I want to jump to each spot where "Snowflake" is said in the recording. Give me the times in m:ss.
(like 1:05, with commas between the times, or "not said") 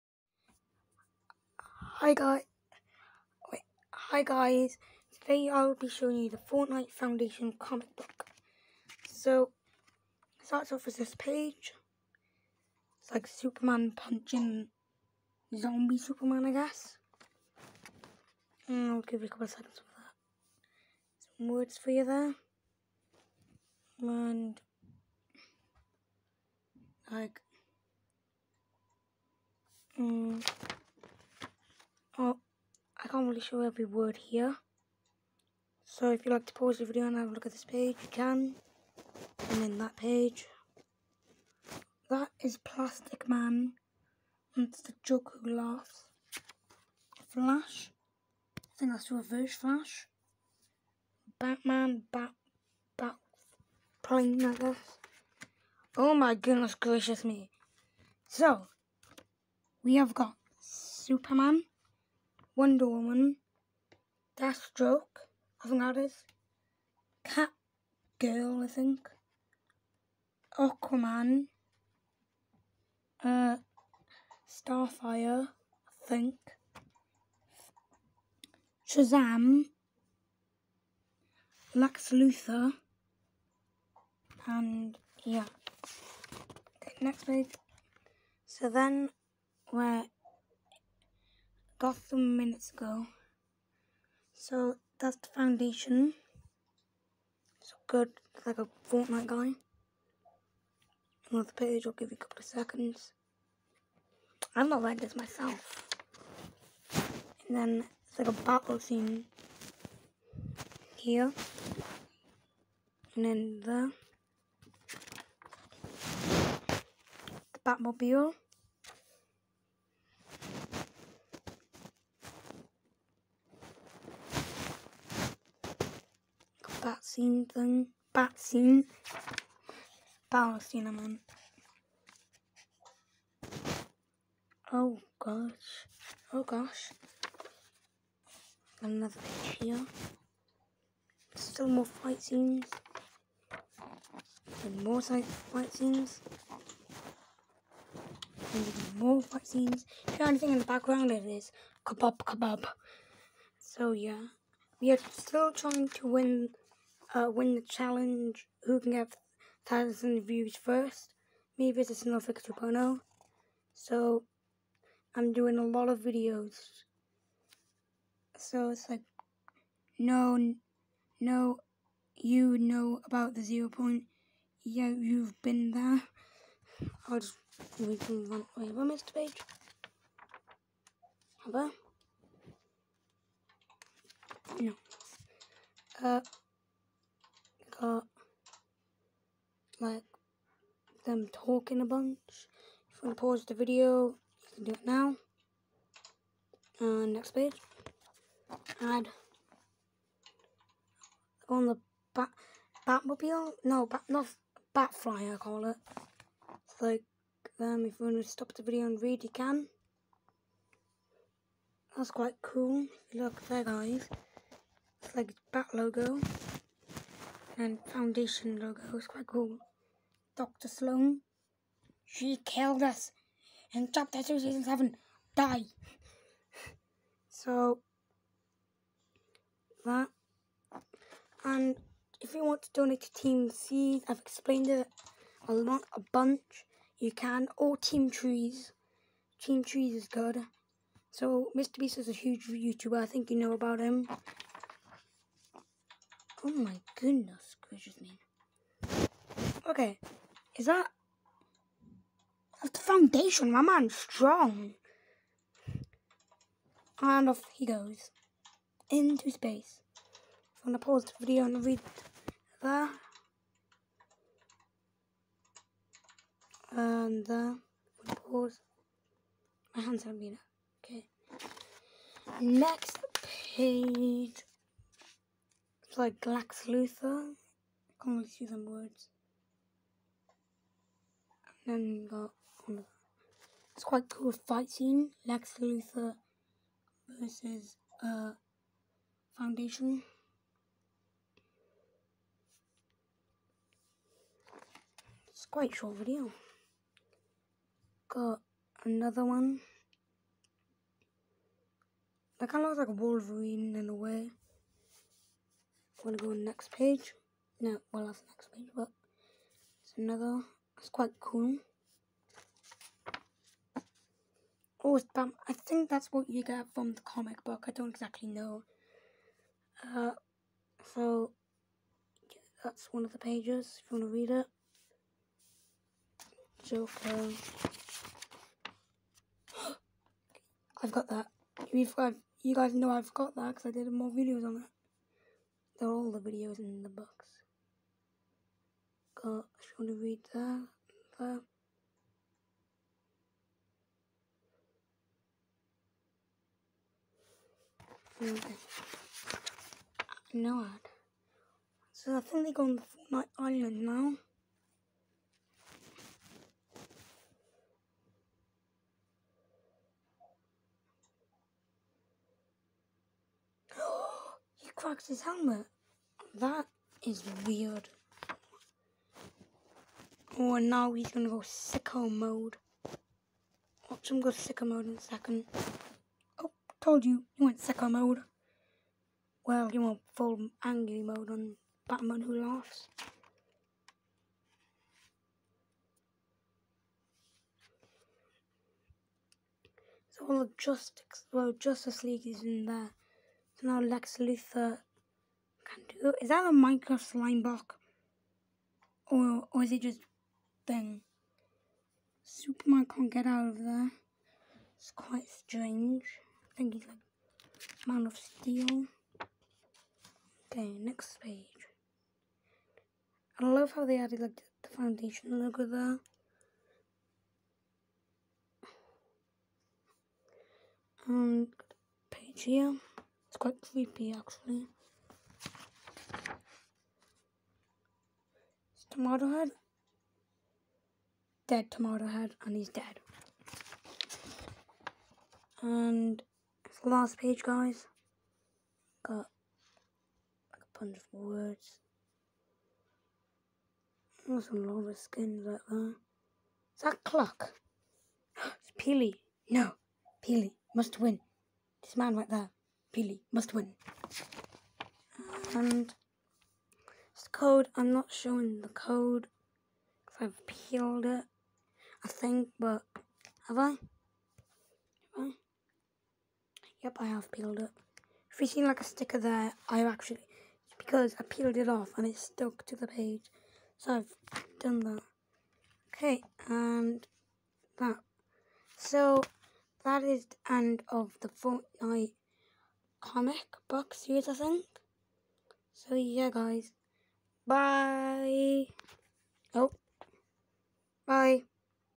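2:41.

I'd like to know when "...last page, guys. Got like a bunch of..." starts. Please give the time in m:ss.
7:16.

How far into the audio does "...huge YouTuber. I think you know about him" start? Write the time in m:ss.
4:02.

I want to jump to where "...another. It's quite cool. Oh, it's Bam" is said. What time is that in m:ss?
5:09.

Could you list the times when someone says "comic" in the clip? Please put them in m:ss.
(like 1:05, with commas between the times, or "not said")
0:07, 5:17, 8:03.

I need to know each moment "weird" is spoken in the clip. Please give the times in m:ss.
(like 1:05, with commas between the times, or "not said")
6:07.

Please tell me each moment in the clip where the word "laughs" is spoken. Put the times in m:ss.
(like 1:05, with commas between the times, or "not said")
0:45, 6:22.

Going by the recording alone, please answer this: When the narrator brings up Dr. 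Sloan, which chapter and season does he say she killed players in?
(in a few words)
Chapter 2, Season 7.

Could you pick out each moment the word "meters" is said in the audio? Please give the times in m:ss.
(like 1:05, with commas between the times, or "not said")
not said.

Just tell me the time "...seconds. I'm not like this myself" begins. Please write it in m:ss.
1:42.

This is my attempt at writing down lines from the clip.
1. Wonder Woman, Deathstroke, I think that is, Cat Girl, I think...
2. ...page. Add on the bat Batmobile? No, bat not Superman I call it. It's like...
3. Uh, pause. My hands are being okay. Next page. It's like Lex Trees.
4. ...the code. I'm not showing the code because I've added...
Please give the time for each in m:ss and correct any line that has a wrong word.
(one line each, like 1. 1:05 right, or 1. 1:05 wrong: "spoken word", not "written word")
1. 1:02 right
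2. 3:17 wrong: "Batfly", not "Superman"
3. 4:28 wrong: "Luthor", not "Trees"
4. 7:37 wrong: "peeled", not "added".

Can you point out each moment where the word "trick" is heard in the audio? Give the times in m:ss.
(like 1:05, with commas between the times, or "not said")
not said.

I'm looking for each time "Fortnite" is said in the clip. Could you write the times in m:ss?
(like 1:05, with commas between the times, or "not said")
0:06, 1:38, 5:52, 8:01.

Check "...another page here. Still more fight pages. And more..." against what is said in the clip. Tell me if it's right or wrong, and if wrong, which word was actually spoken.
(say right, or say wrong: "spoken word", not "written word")
wrong: "scenes", not "pages".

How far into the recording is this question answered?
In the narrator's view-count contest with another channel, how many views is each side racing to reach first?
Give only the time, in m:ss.
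2:39.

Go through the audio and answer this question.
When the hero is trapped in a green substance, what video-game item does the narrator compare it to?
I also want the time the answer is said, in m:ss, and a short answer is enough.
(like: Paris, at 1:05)
Minecraft slime block, at 6:36.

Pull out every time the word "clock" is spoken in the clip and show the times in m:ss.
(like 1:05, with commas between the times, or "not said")
7:27.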